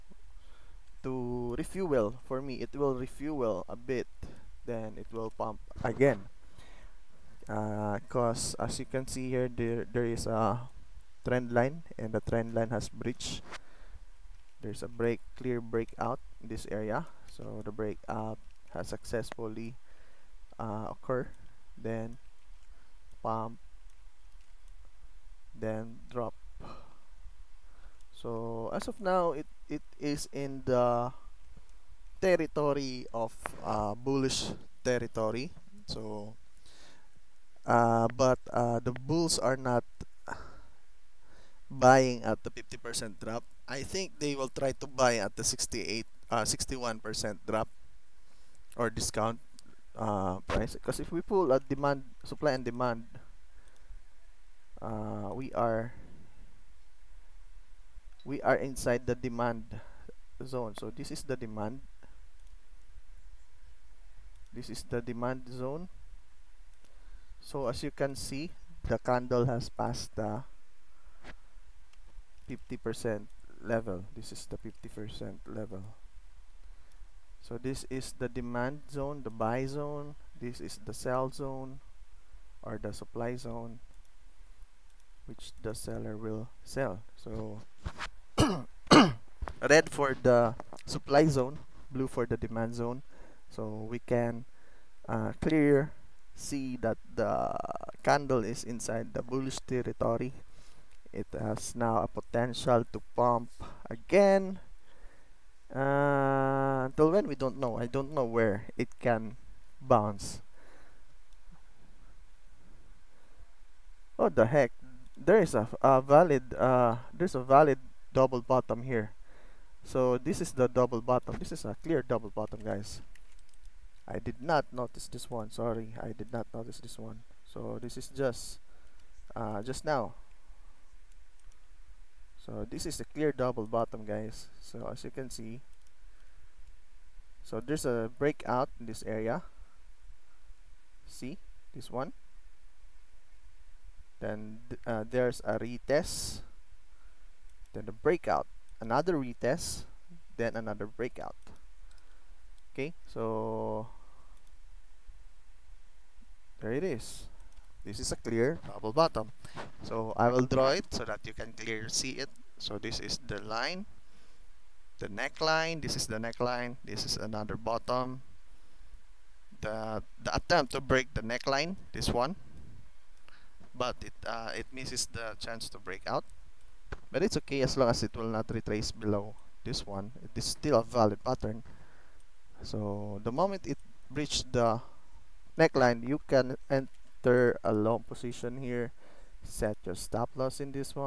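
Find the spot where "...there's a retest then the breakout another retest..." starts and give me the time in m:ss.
2:25.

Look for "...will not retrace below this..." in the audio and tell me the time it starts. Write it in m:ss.
2:58.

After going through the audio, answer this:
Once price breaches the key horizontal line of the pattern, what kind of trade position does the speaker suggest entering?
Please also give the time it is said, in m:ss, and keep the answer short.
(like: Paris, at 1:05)
long position, at 3:07.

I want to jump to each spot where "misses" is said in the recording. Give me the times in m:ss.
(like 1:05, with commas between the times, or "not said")
2:54.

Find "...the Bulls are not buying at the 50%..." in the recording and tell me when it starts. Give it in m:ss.
0:38.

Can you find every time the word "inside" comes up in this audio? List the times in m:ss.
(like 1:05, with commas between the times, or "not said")
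0:58, 1:38.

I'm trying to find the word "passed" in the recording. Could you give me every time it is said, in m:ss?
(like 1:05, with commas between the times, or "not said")
1:09.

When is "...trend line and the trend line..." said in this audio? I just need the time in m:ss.
0:11.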